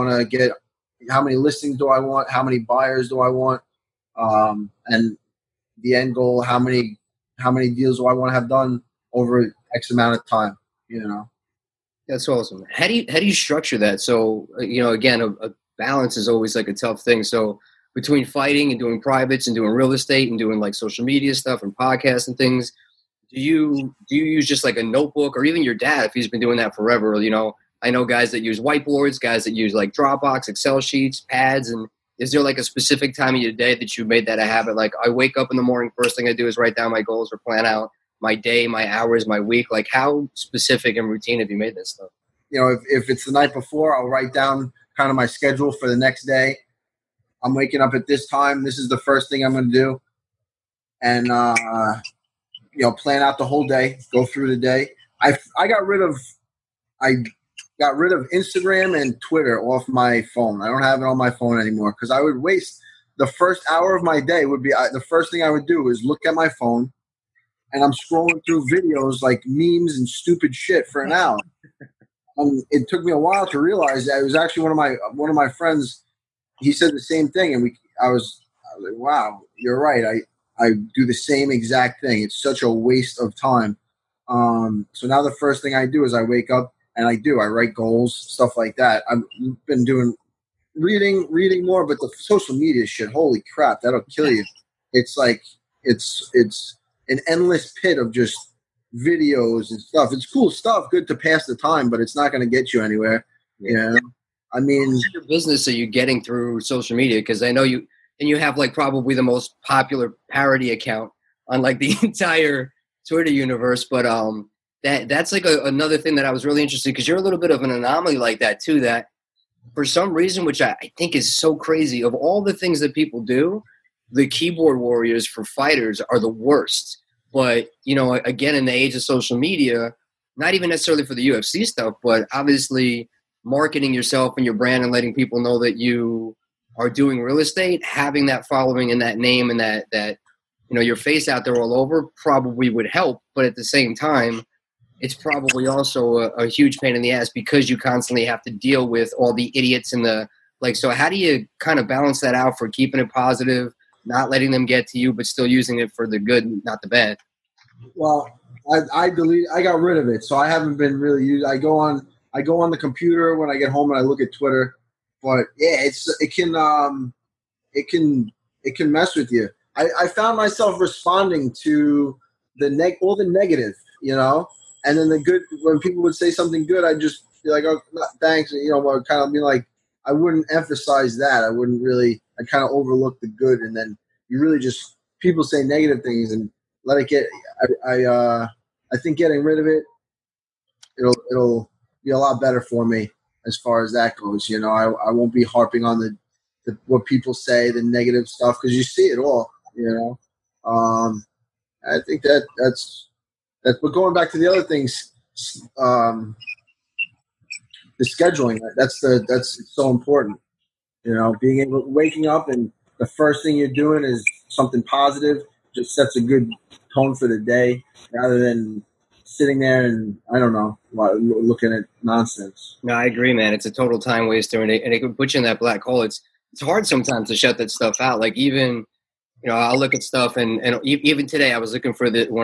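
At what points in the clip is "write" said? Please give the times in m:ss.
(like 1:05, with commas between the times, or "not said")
0:36, 0:44, 1:27.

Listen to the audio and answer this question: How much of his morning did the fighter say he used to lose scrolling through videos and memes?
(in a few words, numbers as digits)
the first hour.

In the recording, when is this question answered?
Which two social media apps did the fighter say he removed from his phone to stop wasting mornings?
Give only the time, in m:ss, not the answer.
0:58.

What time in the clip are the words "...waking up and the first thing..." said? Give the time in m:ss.
3:31.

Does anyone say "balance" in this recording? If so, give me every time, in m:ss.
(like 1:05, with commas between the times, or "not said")
0:15, 2:31.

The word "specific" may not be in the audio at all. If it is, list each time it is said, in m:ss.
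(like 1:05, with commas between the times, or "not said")
0:32, 0:40.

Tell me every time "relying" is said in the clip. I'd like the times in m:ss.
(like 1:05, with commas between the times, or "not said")
not said.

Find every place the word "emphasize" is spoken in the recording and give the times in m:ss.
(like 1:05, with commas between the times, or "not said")
3:00.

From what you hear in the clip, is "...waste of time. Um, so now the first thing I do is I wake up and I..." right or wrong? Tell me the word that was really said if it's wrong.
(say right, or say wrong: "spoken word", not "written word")
right.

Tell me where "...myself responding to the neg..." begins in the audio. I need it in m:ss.
2:50.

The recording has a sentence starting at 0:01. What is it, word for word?
How many listings do I want?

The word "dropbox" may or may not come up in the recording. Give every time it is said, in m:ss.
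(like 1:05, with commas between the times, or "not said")
0:29.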